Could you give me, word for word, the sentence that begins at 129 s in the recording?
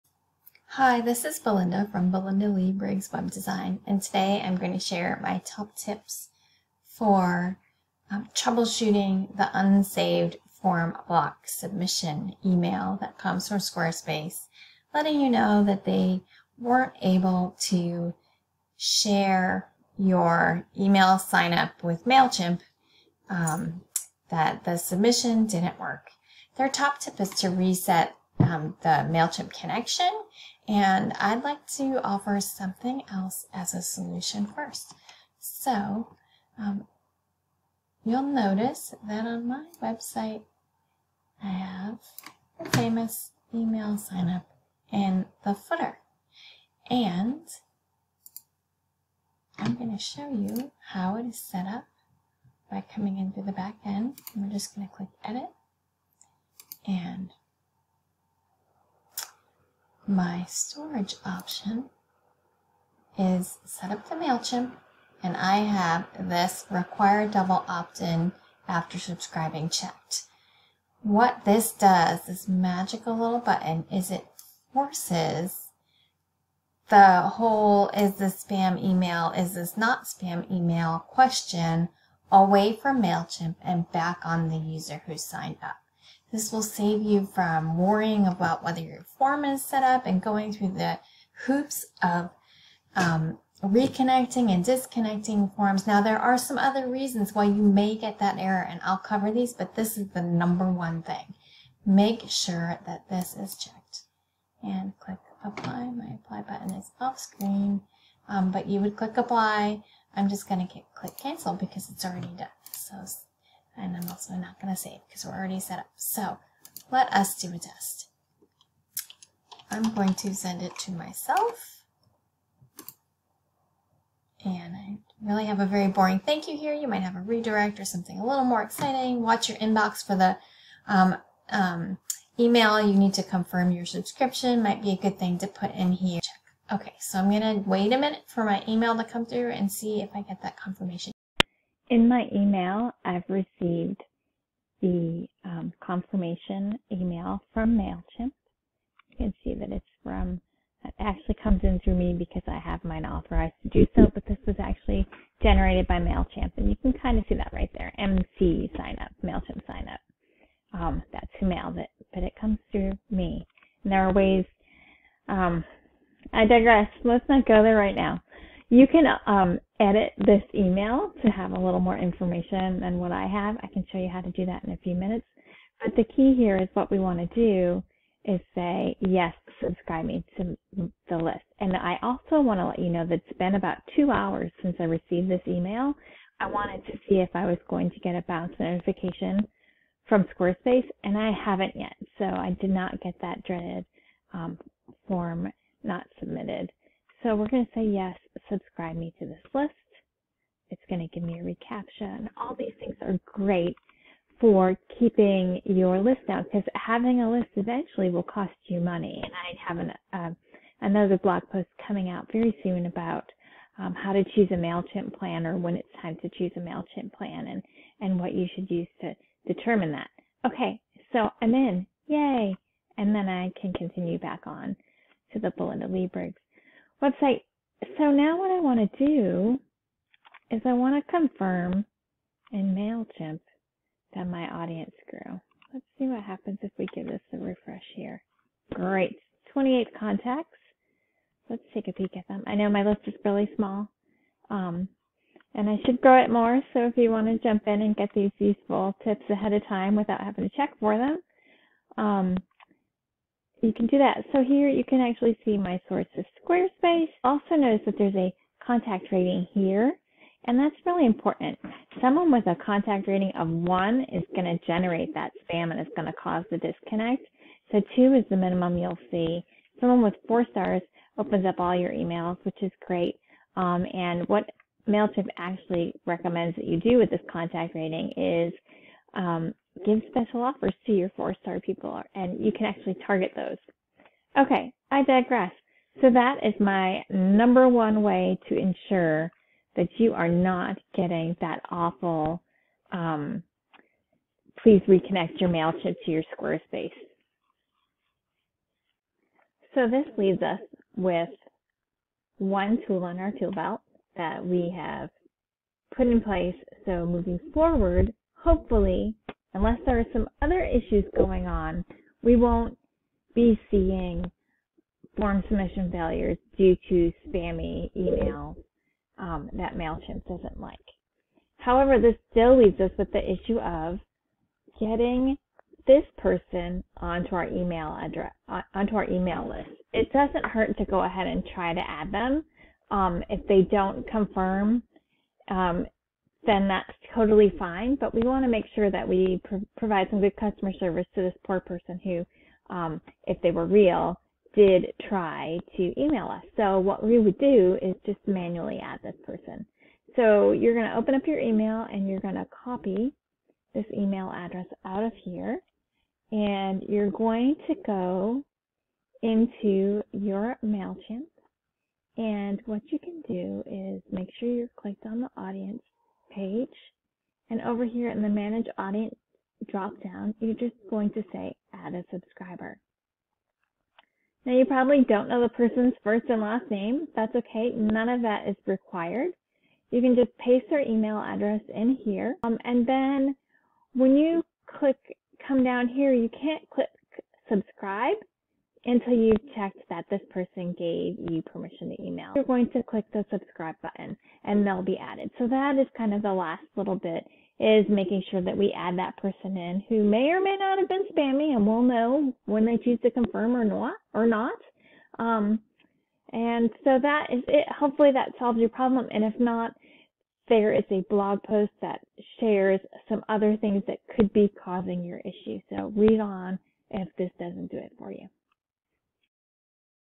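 Watch your inbox for the um, um, email.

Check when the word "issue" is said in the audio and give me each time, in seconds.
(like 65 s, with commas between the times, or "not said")
310 s, 323 s, 415 s.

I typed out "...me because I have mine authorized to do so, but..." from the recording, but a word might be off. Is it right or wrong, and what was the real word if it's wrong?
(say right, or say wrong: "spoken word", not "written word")
right.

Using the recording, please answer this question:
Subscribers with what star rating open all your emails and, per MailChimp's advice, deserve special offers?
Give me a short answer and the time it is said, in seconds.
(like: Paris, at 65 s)
4 stars, at 270 s.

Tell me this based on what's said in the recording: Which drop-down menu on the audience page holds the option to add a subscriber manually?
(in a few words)
Manage Audience.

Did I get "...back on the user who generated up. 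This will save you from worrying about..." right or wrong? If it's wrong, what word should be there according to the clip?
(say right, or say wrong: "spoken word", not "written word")
wrong: "signed", not "generated".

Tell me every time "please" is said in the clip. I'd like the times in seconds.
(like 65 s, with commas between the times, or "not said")
294 s.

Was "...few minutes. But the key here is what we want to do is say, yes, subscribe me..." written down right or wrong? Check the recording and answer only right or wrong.
right.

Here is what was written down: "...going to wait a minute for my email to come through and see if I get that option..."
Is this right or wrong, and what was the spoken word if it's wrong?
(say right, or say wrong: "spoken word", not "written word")
wrong: "confirmation", not "option".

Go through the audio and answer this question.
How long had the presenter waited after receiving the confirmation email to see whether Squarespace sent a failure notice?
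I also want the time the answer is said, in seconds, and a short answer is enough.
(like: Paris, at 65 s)
about two hours, at 183 s.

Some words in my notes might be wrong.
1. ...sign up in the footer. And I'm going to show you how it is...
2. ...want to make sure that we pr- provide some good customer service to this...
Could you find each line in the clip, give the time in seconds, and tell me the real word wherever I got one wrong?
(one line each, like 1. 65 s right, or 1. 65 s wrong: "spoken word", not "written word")
1. 43 s right
2. 338 s right.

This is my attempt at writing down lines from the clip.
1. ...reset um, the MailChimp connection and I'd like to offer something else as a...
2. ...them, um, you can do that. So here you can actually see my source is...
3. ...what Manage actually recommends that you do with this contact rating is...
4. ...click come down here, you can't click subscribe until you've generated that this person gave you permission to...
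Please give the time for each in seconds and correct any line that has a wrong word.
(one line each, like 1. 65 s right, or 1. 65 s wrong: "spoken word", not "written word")
1. 27 s right
2. 250 s right
3. 274 s wrong: "MailChimp", not "Manage"
4. 384 s wrong: "checked", not "generated".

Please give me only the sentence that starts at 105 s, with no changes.
My apply button is off screen, um, but you would click apply.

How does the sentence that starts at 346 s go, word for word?
So what we would do is just manually add this person.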